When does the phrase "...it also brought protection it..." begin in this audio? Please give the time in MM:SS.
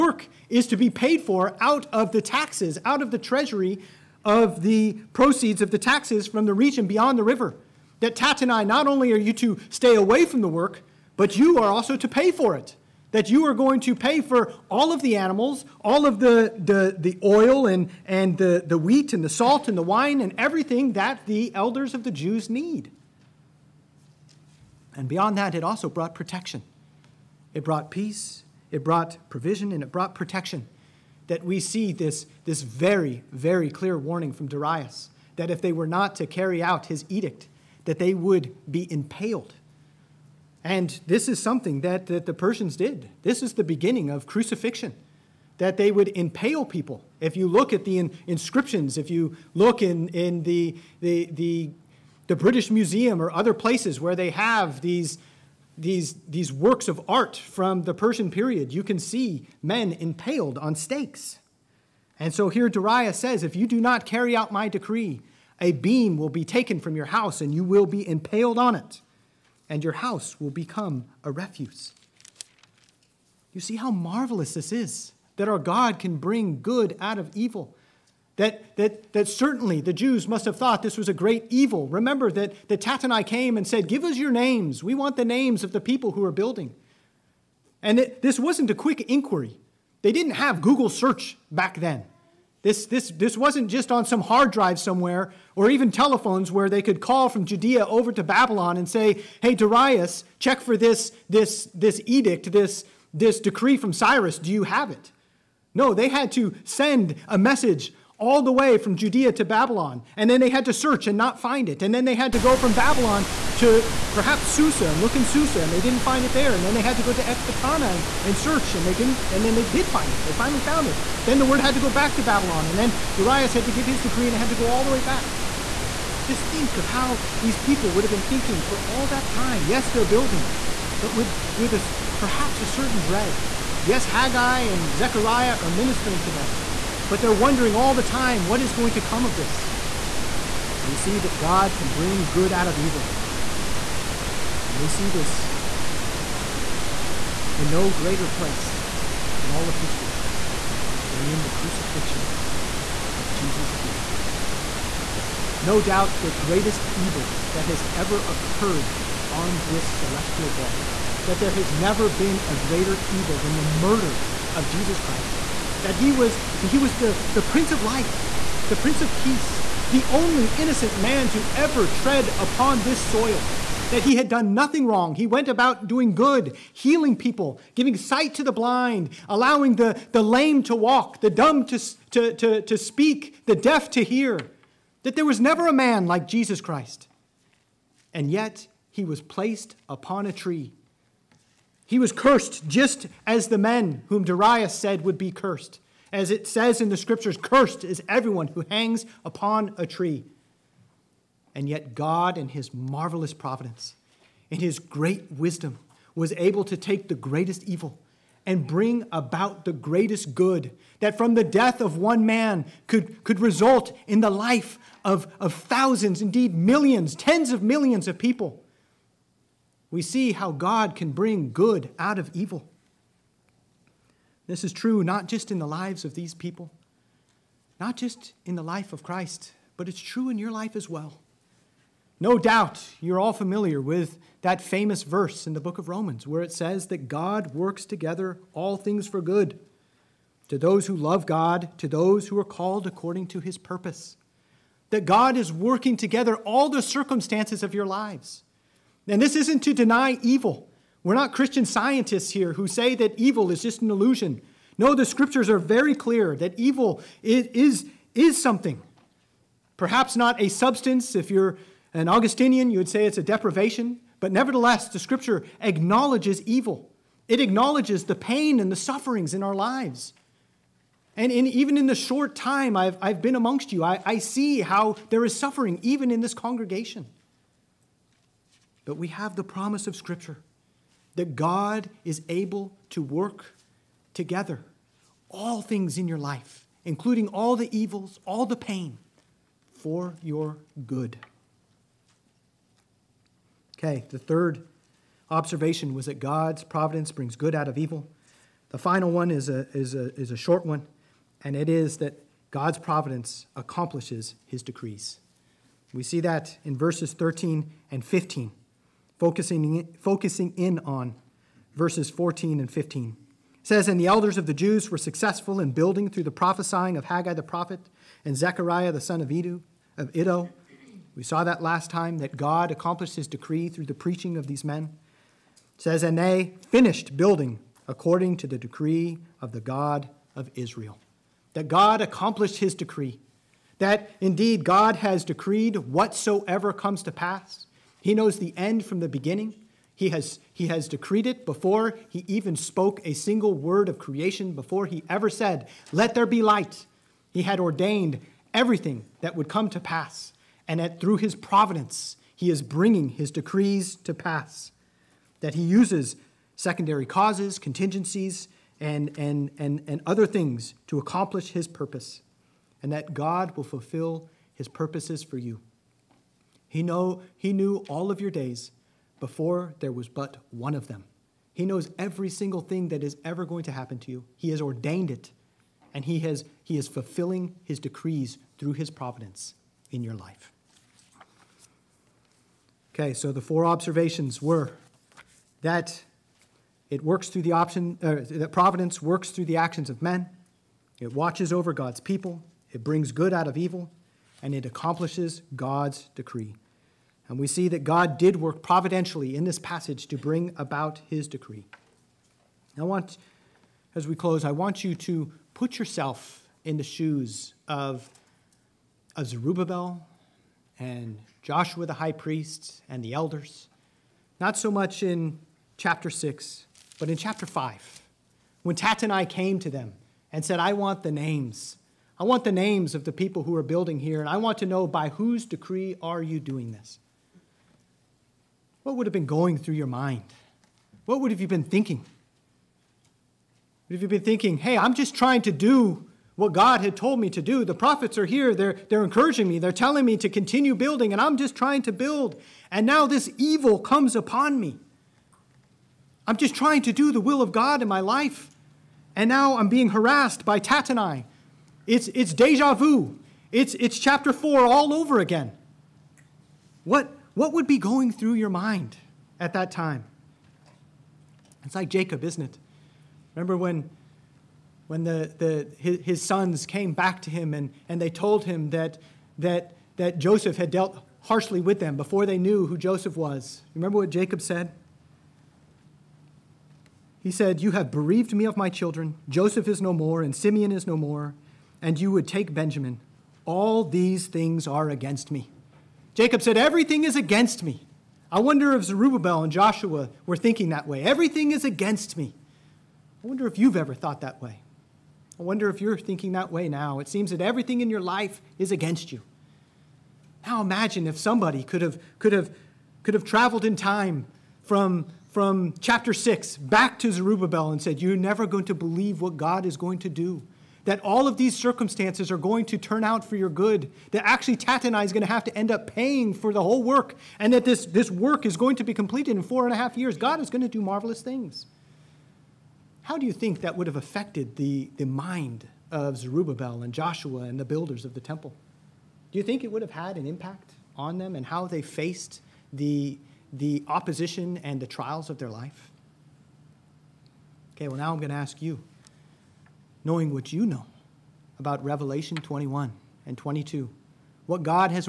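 00:25.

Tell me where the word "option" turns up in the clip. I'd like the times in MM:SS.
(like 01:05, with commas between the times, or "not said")
06:27.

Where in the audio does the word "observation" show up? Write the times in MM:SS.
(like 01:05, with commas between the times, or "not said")
04:55, 06:23.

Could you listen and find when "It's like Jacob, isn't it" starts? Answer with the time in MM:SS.
07:41.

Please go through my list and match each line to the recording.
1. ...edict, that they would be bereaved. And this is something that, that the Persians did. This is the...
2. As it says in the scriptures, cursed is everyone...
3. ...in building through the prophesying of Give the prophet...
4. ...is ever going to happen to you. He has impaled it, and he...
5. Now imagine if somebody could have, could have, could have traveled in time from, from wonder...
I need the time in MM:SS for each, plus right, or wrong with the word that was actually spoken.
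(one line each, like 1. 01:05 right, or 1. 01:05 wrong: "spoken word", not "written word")
1. 00:37 wrong: "impaled", not "bereaved"
2. 03:16 right
3. 05:15 wrong: "Haggai", not "Give"
4. 06:13 wrong: "ordained", not "impaled"
5. 08:20 wrong: "chapter", not "wonder".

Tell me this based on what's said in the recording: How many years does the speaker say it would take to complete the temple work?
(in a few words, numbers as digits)
4 and a half years.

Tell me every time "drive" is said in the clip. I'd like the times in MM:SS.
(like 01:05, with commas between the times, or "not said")
01:34.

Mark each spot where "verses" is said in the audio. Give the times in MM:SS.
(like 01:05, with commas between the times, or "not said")
03:55, 05:06, 05:11.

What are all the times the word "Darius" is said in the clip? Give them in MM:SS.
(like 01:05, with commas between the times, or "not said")
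00:34, 01:02, 01:39, 02:03, 03:14.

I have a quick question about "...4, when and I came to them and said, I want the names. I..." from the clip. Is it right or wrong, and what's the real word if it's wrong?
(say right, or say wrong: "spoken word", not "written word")
wrong: "5", not "4".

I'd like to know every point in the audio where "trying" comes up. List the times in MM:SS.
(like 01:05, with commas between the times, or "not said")
07:15, 07:21, 07:26.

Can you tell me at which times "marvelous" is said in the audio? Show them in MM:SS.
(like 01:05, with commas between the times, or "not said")
01:13, 03:22, 08:40.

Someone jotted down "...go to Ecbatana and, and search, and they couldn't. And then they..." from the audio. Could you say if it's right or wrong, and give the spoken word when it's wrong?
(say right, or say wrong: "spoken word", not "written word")
right.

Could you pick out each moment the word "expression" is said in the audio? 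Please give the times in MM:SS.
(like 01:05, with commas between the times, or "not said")
not said.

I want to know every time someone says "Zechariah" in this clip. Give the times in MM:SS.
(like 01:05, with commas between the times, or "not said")
02:14, 05:18.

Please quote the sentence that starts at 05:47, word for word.
He had ordained everything that would come to pass, and that through his providence, he is bringing his decrees to pass.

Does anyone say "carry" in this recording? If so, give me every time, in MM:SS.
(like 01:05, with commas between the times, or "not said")
00:36, 01:04.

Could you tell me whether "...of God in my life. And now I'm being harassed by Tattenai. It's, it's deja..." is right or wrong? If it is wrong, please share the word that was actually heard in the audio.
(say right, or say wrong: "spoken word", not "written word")
right.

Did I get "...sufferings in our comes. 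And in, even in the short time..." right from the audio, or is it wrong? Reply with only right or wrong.
wrong.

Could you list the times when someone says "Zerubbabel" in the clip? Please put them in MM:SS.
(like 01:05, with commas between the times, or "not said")
06:49, 08:08, 08:27, 08:46.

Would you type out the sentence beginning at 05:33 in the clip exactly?
That indeed God has decreed whatsoever comes to pass.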